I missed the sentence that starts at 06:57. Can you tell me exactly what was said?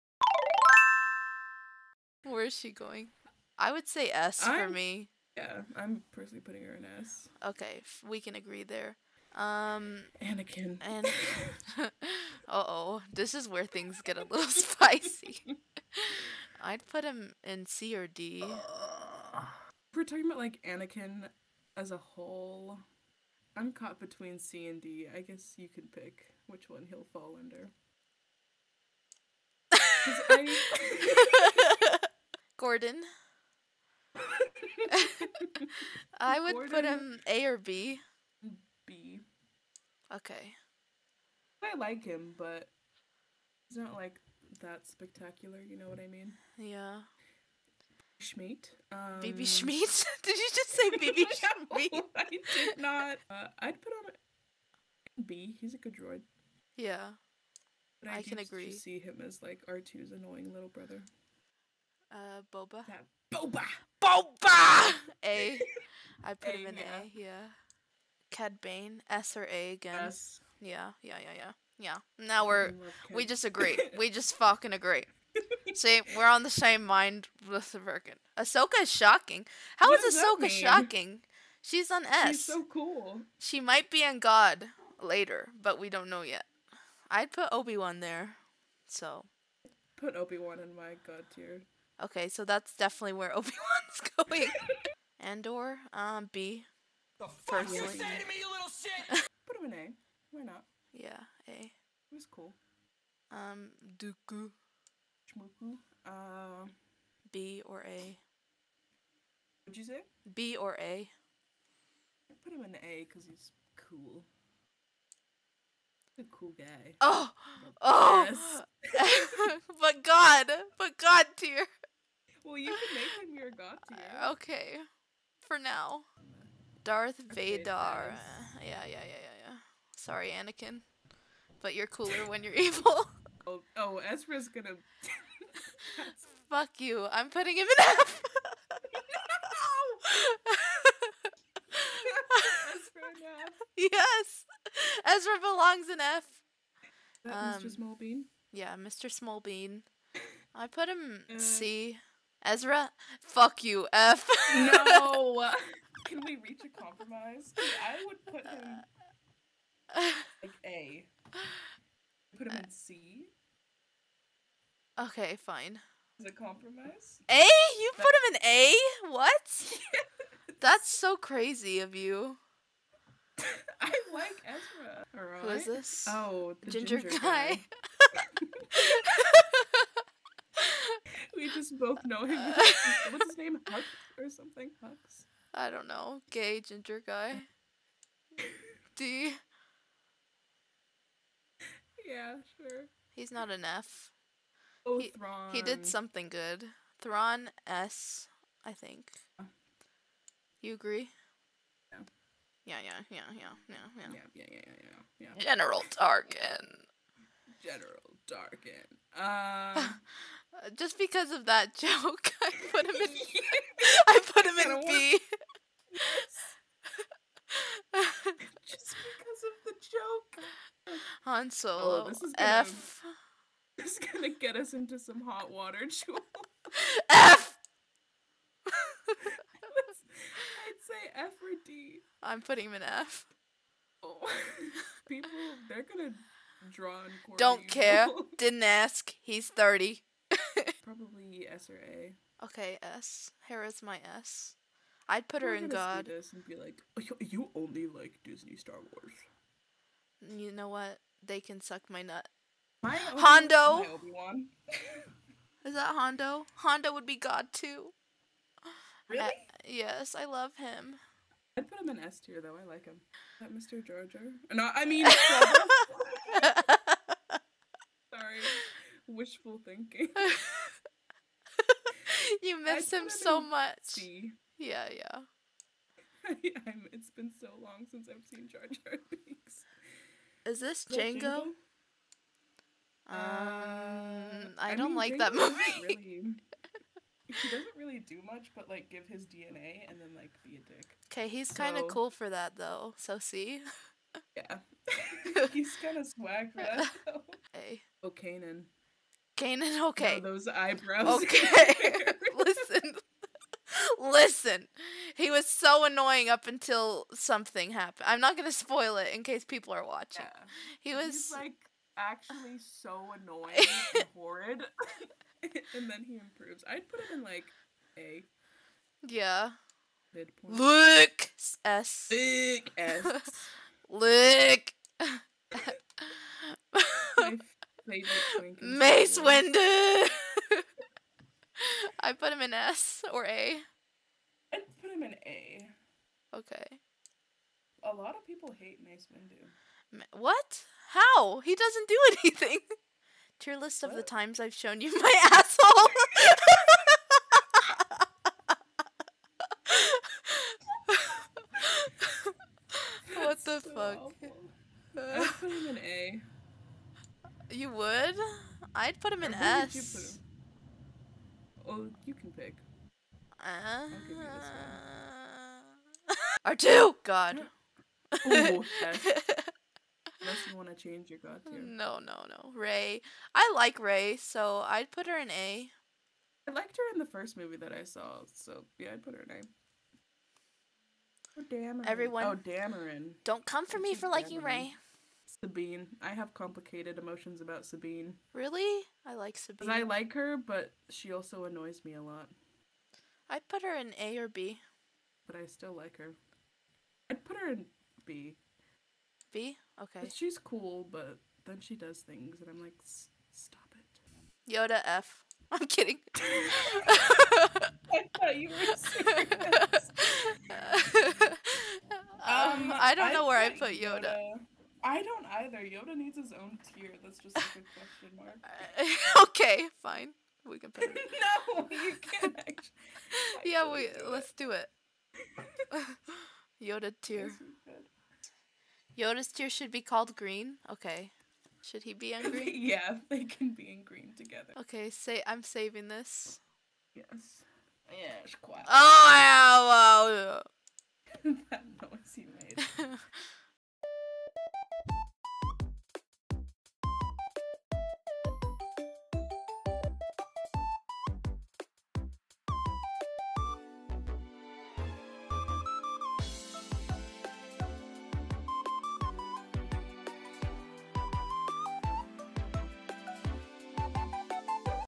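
That's just like a question mark.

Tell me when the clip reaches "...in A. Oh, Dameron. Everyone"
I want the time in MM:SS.
06:19.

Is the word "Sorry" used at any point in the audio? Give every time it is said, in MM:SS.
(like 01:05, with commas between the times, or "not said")
02:09, 04:26.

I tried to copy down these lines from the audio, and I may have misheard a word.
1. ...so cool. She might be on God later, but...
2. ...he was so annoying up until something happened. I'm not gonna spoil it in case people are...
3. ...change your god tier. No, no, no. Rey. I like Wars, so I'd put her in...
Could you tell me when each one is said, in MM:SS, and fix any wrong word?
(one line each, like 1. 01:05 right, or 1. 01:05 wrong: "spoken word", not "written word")
1. 01:22 right
2. 05:05 right
3. 06:10 wrong: "Rey", not "Wars".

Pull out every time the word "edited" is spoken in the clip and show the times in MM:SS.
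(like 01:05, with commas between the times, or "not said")
not said.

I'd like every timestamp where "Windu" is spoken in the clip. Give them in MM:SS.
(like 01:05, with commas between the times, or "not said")
05:29, 05:39.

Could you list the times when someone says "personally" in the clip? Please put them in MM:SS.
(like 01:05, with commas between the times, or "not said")
00:06.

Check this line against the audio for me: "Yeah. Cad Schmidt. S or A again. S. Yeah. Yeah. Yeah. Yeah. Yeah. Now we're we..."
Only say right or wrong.
wrong.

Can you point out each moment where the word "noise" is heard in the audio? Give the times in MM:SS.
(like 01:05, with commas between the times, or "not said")
07:21.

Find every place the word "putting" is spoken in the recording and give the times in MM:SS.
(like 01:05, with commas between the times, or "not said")
00:06, 02:17, 03:52.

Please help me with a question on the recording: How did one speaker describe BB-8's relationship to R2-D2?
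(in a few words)
R2's annoying little brother.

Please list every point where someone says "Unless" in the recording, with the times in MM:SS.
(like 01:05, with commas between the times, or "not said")
06:10.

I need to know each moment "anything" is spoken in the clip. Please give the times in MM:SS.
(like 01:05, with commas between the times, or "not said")
05:42.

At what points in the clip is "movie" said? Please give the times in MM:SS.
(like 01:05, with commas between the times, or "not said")
04:45, 06:17.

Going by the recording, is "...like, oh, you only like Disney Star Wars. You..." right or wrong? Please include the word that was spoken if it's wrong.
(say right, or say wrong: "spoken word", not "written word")
right.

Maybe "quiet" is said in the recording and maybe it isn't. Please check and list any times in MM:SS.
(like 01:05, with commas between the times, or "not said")
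07:18.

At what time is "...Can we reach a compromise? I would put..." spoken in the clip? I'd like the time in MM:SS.
02:36.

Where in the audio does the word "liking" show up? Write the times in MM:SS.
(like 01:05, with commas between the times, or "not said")
06:24.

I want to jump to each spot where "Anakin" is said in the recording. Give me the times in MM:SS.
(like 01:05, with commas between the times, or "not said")
00:10, 00:20, 02:10.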